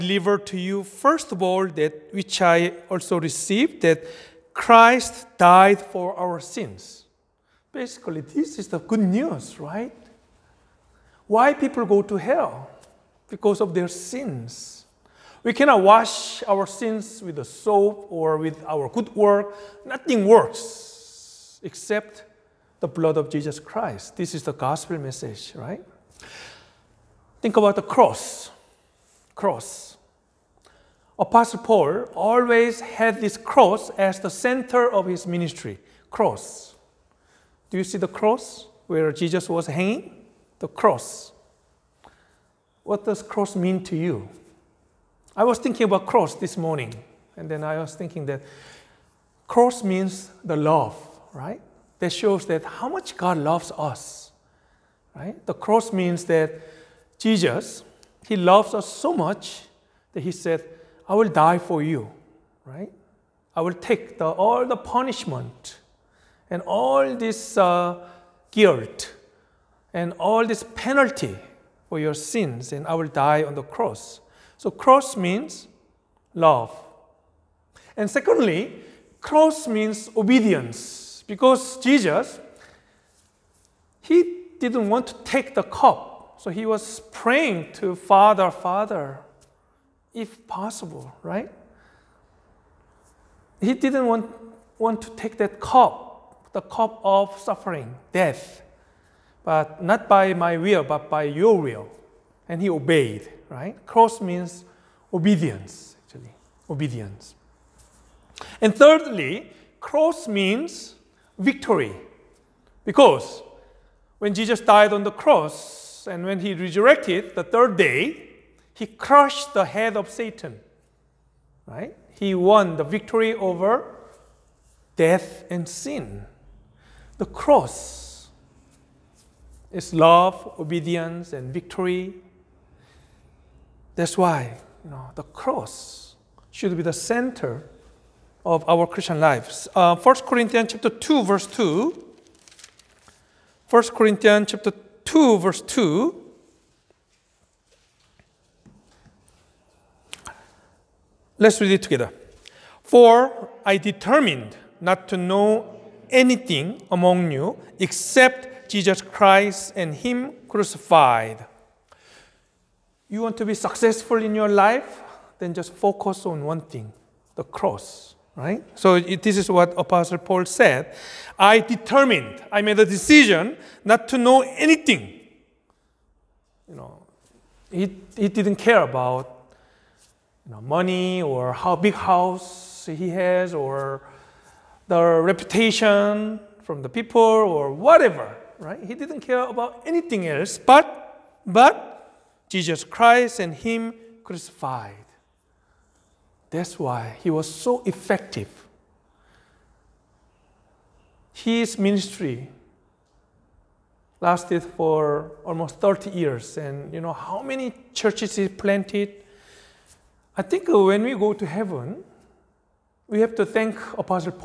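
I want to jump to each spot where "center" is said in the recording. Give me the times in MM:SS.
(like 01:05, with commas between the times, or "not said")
00:34, 02:16.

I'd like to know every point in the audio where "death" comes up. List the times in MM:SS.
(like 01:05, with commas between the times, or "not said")
01:38, 02:04.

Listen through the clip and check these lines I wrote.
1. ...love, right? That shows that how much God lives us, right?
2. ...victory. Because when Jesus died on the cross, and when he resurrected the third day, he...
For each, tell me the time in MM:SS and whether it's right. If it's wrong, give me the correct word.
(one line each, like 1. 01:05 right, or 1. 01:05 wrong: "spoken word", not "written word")
1. 00:50 wrong: "loves", not "lives"
2. 01:51 right.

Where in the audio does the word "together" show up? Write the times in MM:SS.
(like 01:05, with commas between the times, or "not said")
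02:31.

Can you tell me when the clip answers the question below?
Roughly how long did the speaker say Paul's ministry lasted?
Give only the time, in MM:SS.
03:25.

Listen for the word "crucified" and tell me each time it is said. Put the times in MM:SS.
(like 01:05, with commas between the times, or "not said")
02:40, 03:14.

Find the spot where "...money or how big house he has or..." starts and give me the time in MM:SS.
03:00.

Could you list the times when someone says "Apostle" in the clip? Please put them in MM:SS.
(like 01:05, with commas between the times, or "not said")
00:31, 02:49.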